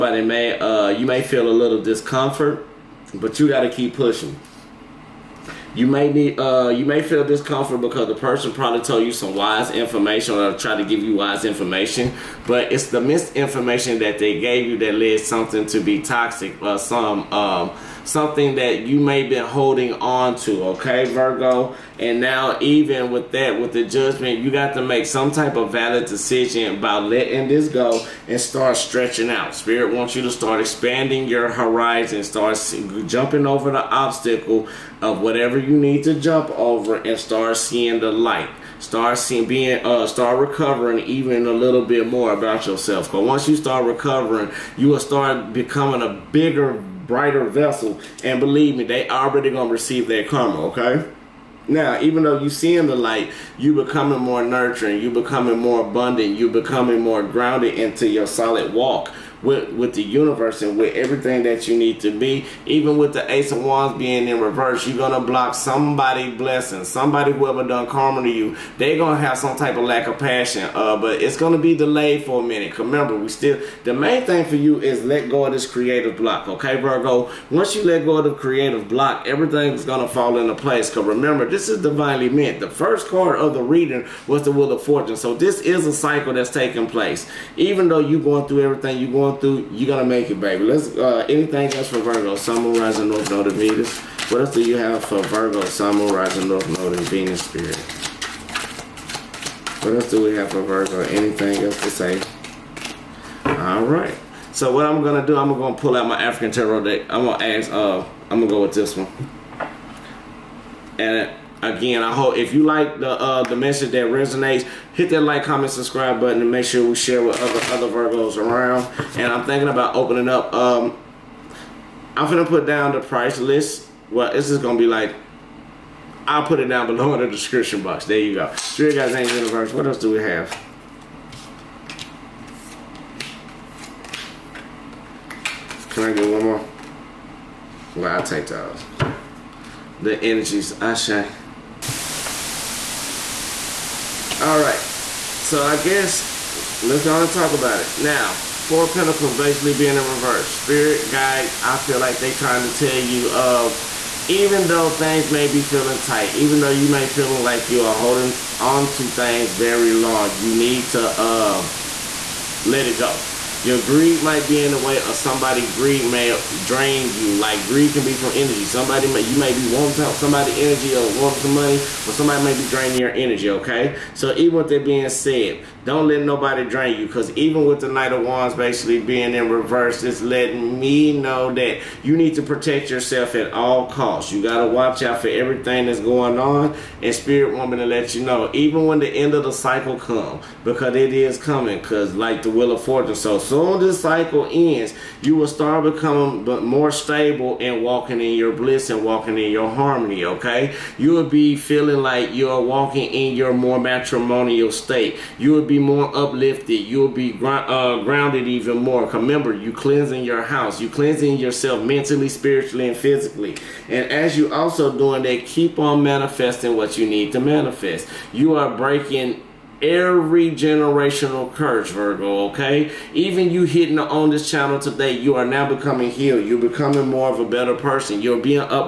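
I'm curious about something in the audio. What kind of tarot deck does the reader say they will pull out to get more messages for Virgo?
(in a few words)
African tarot deck.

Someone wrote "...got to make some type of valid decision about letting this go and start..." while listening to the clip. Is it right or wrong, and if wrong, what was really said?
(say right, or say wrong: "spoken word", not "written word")
right.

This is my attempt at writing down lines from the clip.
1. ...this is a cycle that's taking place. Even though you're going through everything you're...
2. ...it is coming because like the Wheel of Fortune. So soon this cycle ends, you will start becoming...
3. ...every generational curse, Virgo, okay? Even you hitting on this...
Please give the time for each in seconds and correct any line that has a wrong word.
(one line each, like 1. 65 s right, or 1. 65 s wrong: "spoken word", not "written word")
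1. 85 s right
2. 190 s right
3. 219 s right.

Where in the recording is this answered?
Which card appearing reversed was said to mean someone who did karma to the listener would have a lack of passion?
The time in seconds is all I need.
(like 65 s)
63 s.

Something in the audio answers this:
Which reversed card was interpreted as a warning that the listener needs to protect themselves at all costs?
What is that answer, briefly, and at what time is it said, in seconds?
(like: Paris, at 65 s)
Knight of Wands, at 177 s.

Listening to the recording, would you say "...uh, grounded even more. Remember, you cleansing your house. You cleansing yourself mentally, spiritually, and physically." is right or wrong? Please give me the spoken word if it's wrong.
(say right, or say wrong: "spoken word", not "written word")
right.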